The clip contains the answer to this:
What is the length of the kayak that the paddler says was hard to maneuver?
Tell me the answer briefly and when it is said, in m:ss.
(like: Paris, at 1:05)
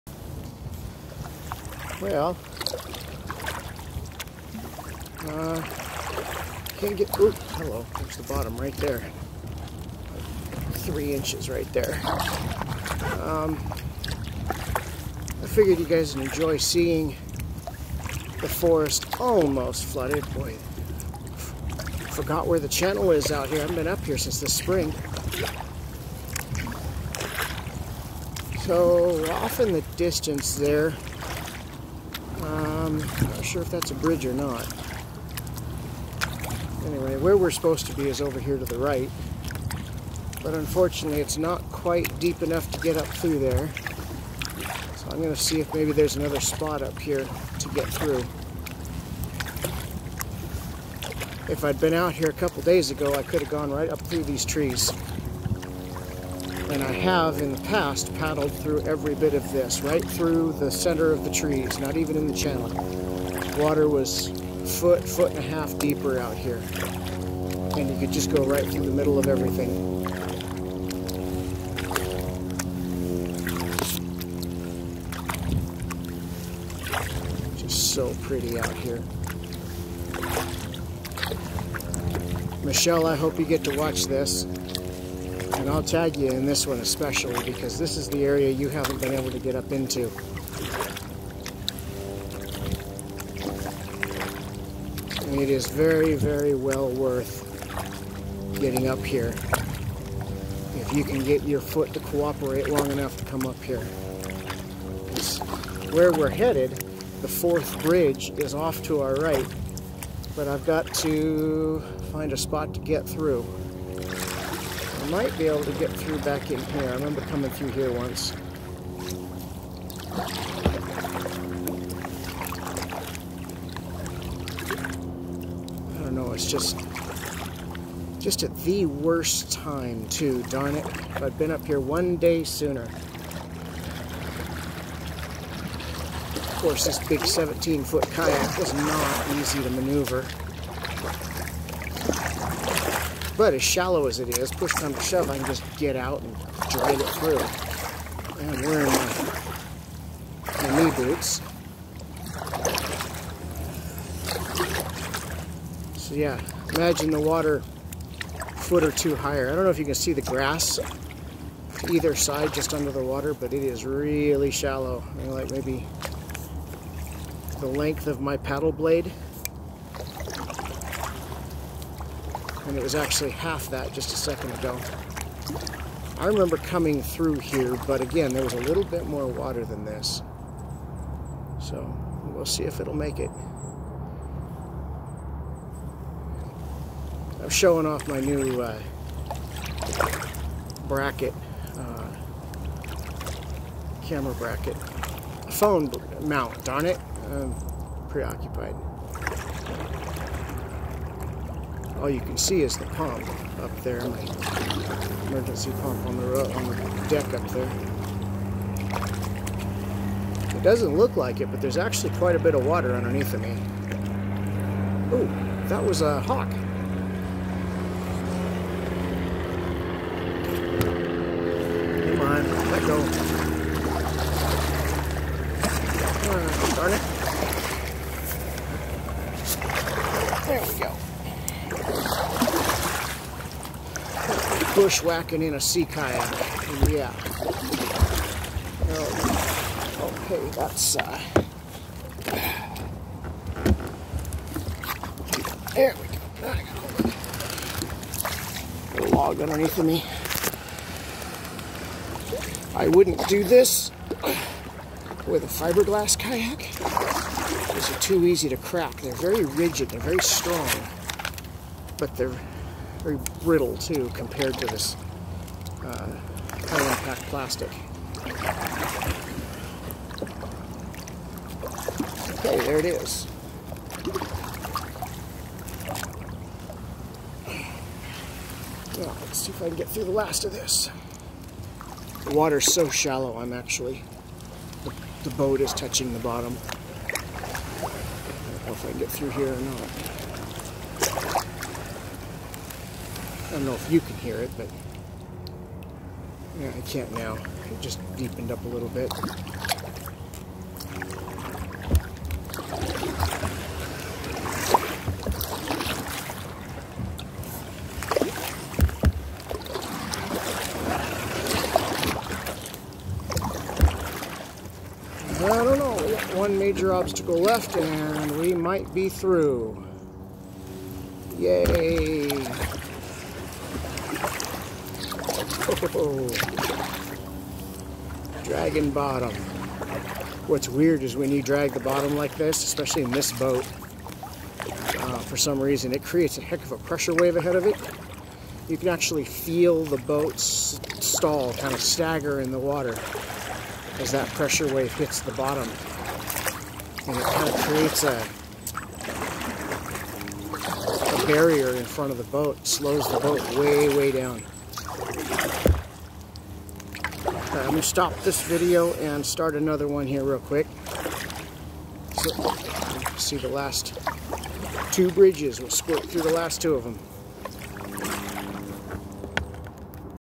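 17 feet, at 2:17.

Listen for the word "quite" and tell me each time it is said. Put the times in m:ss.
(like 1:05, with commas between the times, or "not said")
0:41, 3:32.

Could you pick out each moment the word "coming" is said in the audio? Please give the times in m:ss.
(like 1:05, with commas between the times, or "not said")
1:57, 2:56.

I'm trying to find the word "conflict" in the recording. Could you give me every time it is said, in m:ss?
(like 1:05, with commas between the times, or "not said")
not said.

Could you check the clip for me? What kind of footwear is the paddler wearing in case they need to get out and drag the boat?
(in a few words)
knee boots.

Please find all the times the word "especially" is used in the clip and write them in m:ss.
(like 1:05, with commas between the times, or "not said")
1:26, 5:32.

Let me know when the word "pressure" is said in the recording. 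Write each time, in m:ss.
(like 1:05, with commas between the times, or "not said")
5:36, 5:44.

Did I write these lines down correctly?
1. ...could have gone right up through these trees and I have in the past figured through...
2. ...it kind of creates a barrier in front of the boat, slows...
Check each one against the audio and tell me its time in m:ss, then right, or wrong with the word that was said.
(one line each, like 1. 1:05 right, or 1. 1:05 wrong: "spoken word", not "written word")
1. 0:53 wrong: "paddled", not "figured"
2. 5:47 right.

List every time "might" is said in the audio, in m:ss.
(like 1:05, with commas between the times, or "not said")
1:55, 5:18.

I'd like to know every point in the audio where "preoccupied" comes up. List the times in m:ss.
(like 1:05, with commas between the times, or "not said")
3:18.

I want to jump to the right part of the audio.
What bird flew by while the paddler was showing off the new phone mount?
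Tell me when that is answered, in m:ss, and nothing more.
3:36.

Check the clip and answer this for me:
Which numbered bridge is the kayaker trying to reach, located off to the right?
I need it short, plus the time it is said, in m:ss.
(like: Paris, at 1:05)
fourth, at 1:47.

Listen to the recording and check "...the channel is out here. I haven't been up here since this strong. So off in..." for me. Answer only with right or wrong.
wrong.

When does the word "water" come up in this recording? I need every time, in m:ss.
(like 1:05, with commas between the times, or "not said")
1:03, 2:37, 2:43, 2:59, 3:32, 4:42, 5:42.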